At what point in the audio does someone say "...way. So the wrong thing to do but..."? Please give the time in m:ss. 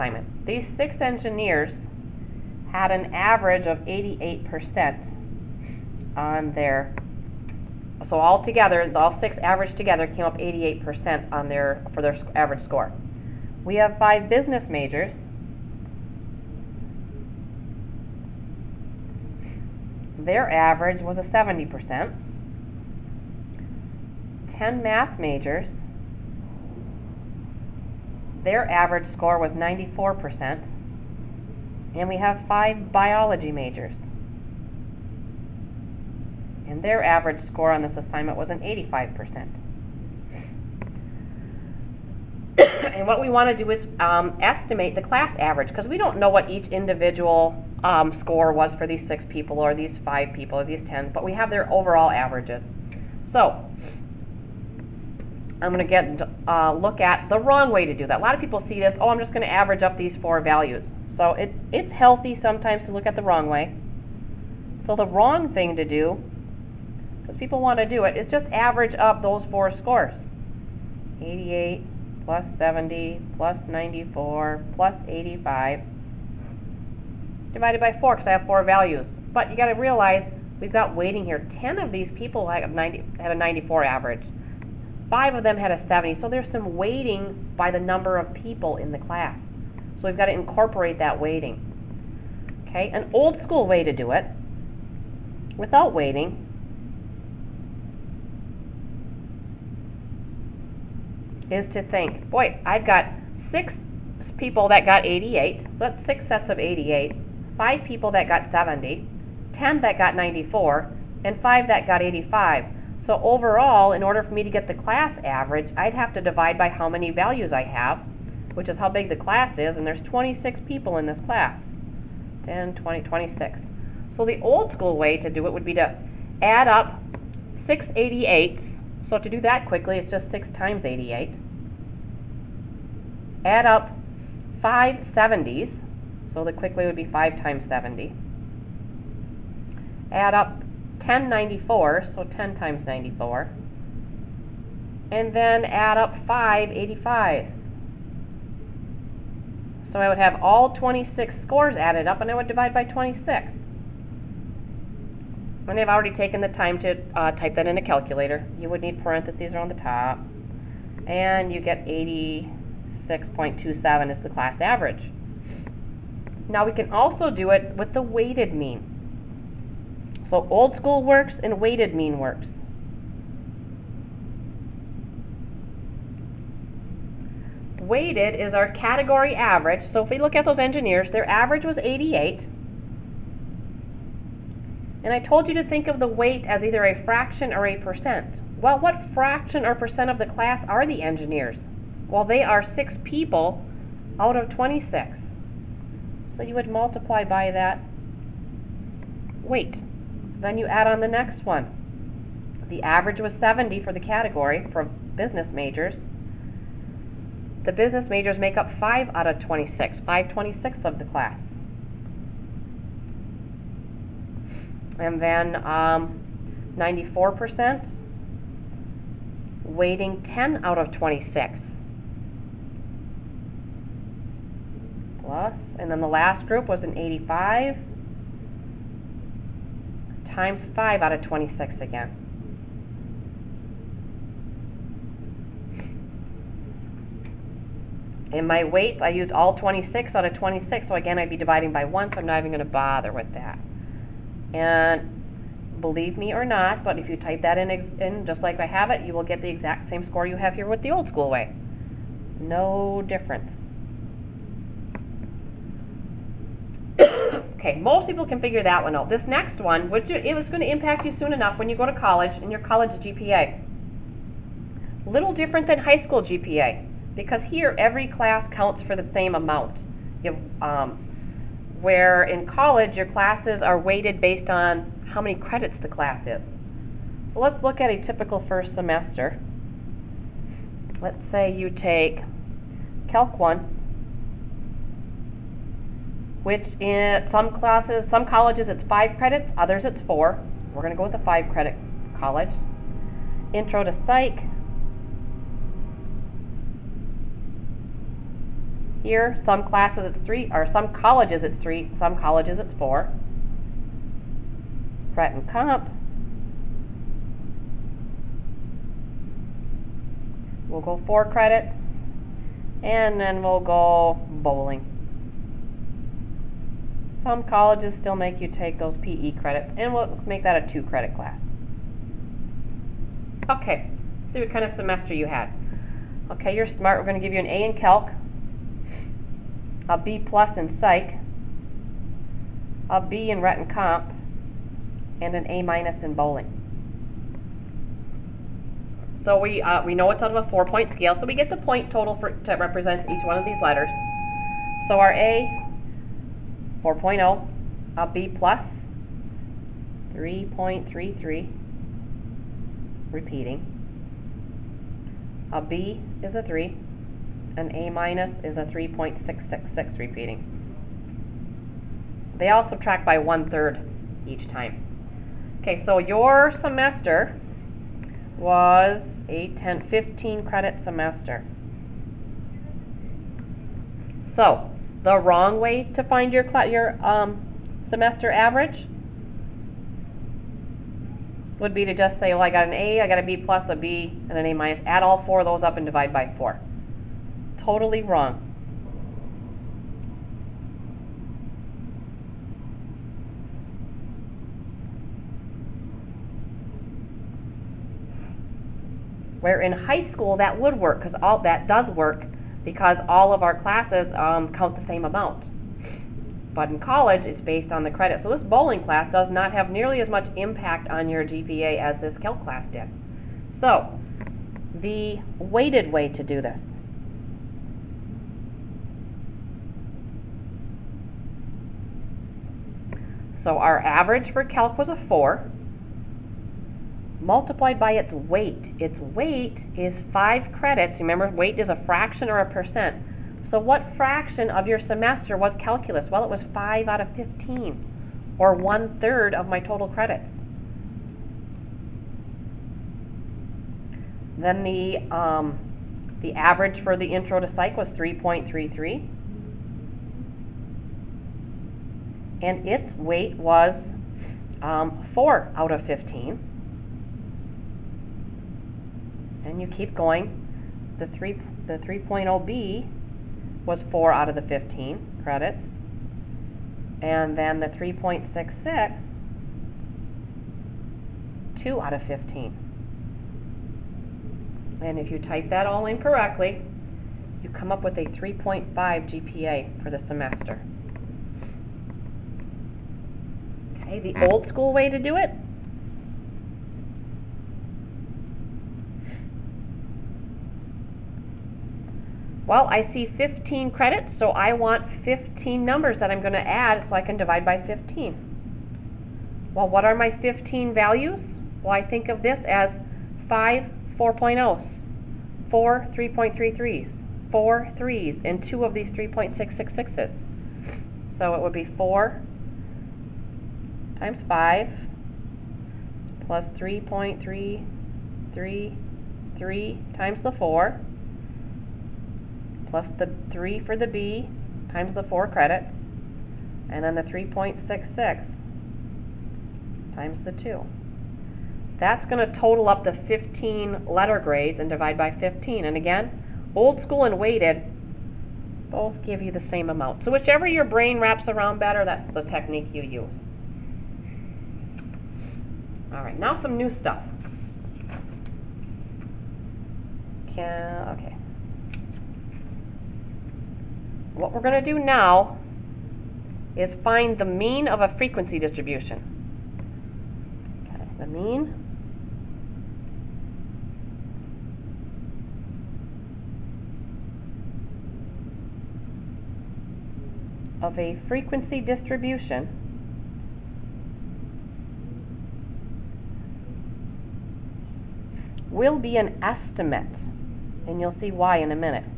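1:03.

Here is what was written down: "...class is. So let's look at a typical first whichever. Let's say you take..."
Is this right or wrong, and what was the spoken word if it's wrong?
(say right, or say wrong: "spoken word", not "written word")
wrong: "semester", not "whichever".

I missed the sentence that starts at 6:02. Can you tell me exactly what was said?
They all subtract by one third each time.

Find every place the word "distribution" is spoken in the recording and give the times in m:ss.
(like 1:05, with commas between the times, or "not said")
9:18, 9:31.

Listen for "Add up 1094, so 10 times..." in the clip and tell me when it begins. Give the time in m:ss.
2:20.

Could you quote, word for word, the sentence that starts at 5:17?
Some colleges still make you take those PE credits, and we'll make that a two credit class.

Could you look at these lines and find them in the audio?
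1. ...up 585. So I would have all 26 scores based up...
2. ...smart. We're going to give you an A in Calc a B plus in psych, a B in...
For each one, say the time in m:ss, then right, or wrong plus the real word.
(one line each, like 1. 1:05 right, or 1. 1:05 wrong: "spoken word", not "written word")
1. 2:25 wrong: "added", not "based"
2. 5:26 right.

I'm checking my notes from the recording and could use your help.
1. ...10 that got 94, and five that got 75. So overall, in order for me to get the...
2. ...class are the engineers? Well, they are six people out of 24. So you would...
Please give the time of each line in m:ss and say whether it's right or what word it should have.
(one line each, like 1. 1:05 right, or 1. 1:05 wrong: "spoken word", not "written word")
1. 1:49 wrong: "85", not "75"
2. 3:10 wrong: "26", not "24".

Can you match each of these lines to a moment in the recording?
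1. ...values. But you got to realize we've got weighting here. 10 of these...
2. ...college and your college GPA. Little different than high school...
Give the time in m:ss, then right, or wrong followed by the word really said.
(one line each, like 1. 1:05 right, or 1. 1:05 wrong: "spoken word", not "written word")
1. 1:18 right
2. 4:21 right.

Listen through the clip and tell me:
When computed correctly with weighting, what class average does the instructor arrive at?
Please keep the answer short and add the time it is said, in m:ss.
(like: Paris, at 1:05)
86.27, at 2:41.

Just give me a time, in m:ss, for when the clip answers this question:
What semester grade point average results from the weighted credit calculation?
7:58.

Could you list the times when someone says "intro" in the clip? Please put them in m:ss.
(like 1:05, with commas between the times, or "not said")
4:53, 7:27.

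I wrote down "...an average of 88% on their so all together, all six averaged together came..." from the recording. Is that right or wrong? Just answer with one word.
right.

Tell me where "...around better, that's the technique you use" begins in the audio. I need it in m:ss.
9:01.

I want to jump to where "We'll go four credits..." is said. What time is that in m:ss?
5:10.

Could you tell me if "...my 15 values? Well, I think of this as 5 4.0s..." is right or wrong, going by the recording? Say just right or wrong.
right.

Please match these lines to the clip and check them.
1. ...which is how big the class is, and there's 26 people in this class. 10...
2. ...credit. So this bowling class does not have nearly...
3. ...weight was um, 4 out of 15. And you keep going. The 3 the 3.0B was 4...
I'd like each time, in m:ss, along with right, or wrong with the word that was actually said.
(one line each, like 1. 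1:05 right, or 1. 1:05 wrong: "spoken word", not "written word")
1. 1:58 right
2. 6:47 right
3. 7:32 right.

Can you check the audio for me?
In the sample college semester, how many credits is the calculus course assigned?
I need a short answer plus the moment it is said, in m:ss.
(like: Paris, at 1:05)
5, at 4:51.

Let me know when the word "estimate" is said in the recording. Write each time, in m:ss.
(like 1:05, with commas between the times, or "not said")
0:44, 9:39.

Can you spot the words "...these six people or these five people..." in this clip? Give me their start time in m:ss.
0:48.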